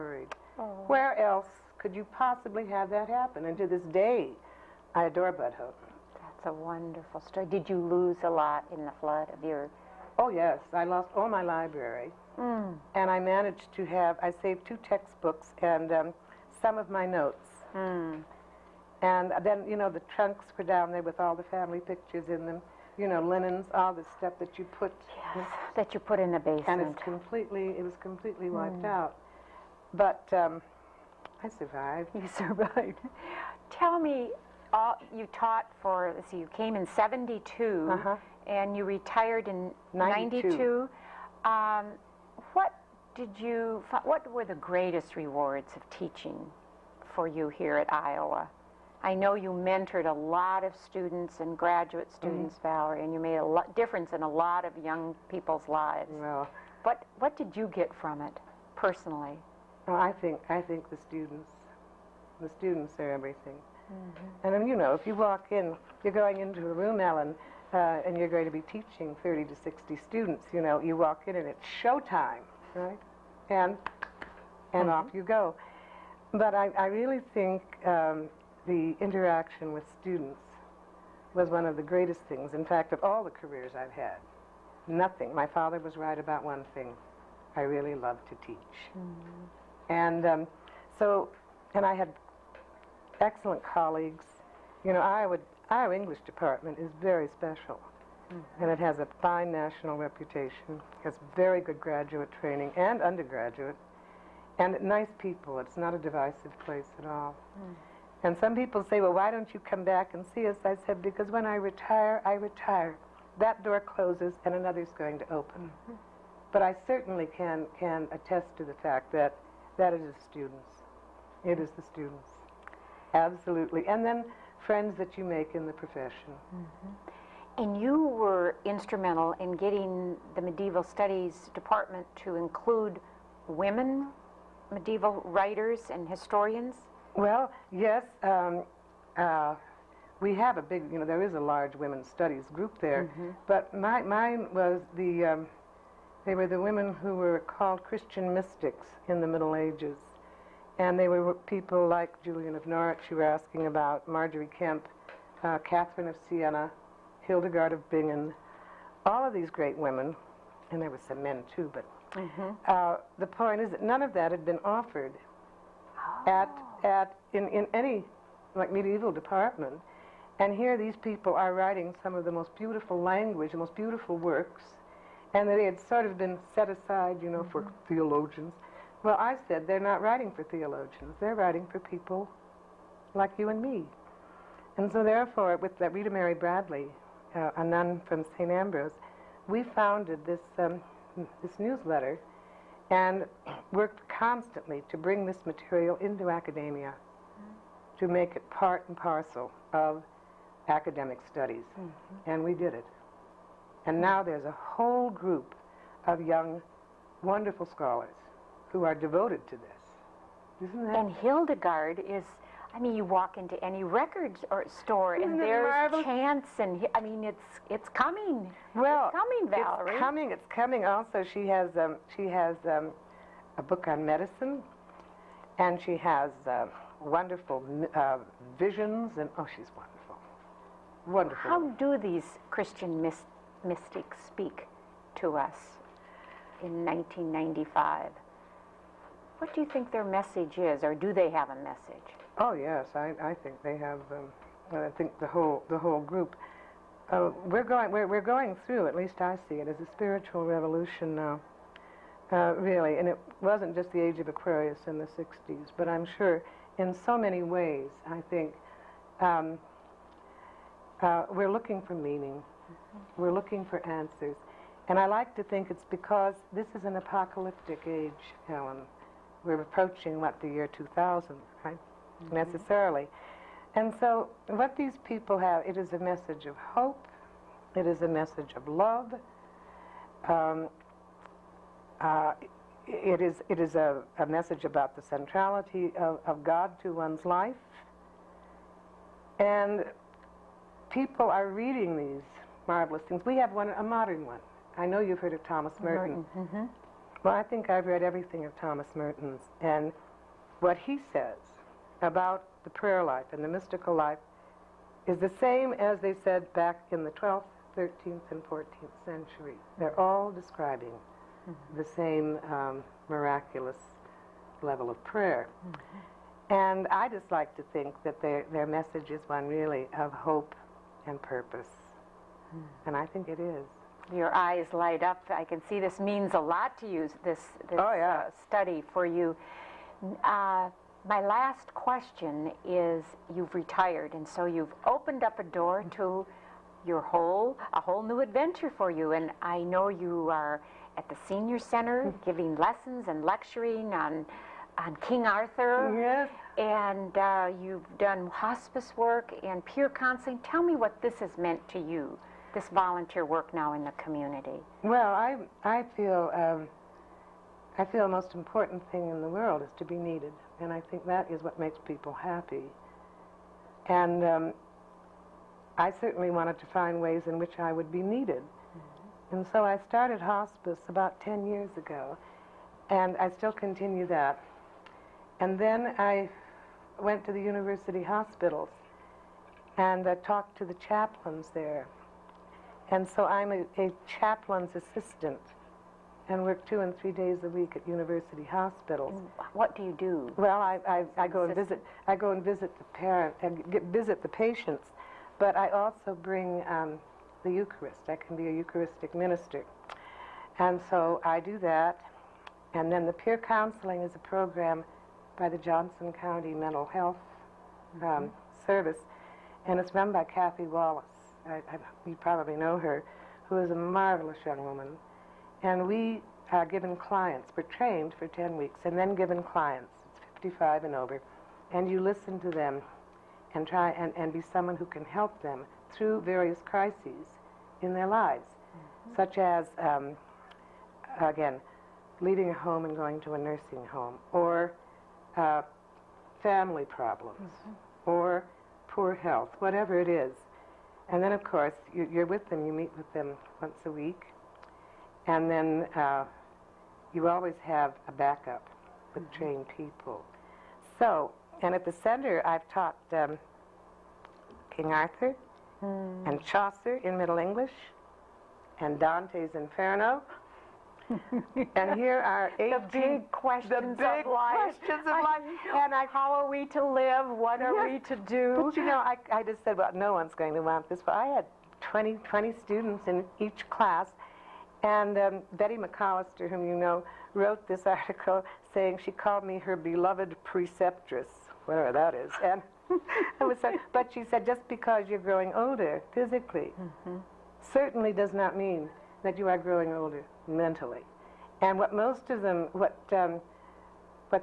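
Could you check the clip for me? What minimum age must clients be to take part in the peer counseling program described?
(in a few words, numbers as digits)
55.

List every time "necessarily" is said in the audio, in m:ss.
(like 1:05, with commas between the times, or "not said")
4:32.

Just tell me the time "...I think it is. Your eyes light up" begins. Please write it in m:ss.
5:22.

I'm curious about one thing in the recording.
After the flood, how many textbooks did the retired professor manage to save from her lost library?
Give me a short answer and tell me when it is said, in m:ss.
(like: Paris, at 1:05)
2, at 0:14.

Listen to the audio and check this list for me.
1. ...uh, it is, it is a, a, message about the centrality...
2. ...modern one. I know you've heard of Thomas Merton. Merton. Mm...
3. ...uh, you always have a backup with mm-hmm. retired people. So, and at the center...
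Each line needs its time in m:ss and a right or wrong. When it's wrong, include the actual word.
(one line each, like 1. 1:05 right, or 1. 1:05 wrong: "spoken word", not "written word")
1. 4:42 right
2. 4:53 right
3. 7:25 wrong: "trained", not "retired".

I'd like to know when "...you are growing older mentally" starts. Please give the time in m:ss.
8:09.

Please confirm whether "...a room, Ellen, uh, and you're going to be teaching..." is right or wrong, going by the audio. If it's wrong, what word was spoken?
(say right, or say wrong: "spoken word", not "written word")
right.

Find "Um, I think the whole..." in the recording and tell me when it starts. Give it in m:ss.
4:04.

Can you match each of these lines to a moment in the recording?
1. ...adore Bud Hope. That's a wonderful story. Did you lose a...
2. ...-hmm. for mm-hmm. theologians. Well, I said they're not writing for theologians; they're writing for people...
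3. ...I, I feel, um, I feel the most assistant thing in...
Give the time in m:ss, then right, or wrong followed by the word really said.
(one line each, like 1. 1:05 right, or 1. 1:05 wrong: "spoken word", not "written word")
1. 0:05 right
2. 2:57 right
3. 5:55 wrong: "important", not "assistant".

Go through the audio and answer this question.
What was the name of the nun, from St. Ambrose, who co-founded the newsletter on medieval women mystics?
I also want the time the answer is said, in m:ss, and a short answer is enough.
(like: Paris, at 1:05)
Ritamary Bradley, at 3:05.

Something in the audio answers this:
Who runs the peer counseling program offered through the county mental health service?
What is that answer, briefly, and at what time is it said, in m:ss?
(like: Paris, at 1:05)
Kathy Wallace, at 6:50.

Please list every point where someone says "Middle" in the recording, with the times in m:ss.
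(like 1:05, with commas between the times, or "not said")
2:29, 7:37.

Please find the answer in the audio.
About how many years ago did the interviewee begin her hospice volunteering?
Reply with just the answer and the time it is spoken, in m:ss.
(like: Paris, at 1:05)
10 years, at 6:11.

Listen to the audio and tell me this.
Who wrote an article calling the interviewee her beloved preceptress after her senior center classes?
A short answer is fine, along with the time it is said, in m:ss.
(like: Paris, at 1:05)
Betty McAllister, at 7:55.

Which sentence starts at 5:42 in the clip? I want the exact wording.
giving lessons and lecturing on, on King Arthur.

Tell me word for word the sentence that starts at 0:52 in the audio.
Valerie, and you made a difference in a lot of young people's lives.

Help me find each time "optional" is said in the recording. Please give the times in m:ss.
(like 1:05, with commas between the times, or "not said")
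not said.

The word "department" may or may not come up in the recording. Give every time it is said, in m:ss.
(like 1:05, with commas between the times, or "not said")
1:36, 2:11, 2:49.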